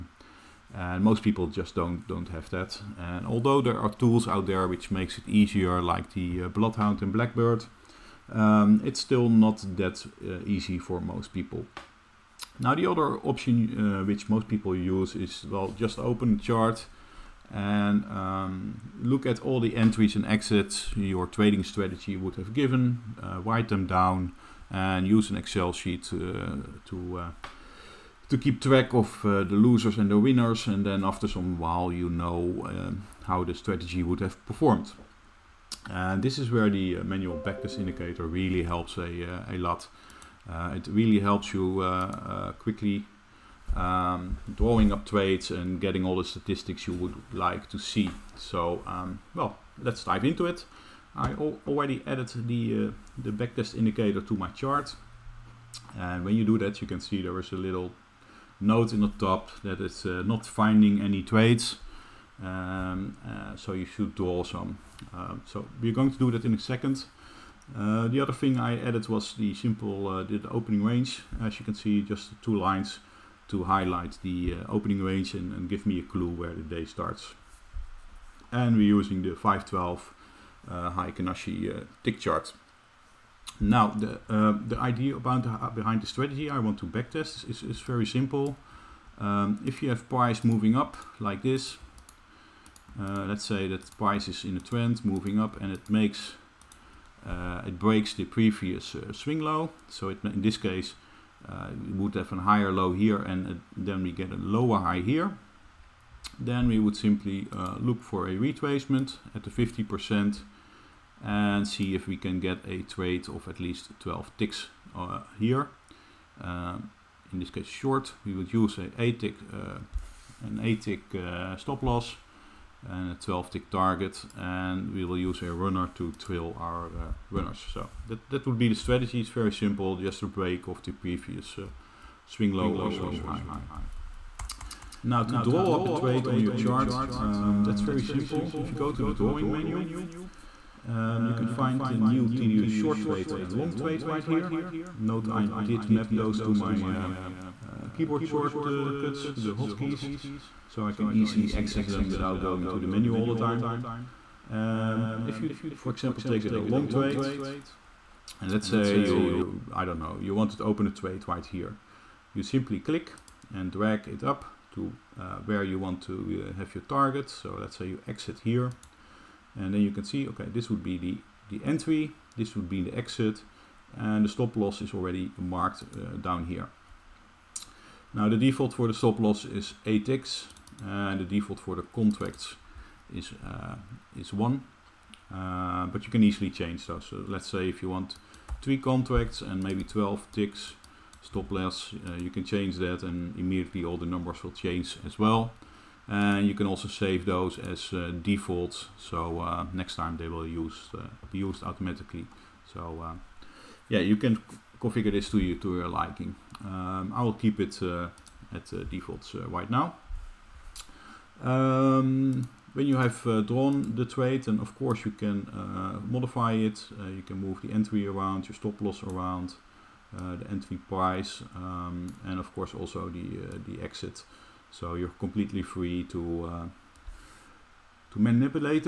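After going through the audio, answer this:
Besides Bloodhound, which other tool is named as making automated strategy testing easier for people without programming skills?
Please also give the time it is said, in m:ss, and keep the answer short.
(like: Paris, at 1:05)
Blackbird, at 0:07.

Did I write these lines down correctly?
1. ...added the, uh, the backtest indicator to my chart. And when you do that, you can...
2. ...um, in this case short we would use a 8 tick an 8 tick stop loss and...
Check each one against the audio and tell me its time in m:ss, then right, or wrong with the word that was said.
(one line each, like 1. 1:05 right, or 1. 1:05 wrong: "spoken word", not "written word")
1. 0:52 right
2. 1:56 right.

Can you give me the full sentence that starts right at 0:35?
And this is where the uh, manual backtest indicator really helps a, uh, a lot.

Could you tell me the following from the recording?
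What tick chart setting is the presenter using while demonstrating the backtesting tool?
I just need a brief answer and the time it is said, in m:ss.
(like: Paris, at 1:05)
512 tick chart, at 1:19.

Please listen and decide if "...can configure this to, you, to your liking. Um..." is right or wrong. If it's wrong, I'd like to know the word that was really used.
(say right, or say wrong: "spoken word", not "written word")
right.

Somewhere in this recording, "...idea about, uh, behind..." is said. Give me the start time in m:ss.
1:24.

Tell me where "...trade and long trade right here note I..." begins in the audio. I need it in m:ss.
2:23.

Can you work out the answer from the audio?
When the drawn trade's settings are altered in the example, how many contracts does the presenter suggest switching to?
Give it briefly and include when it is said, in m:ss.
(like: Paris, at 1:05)
3, at 3:08.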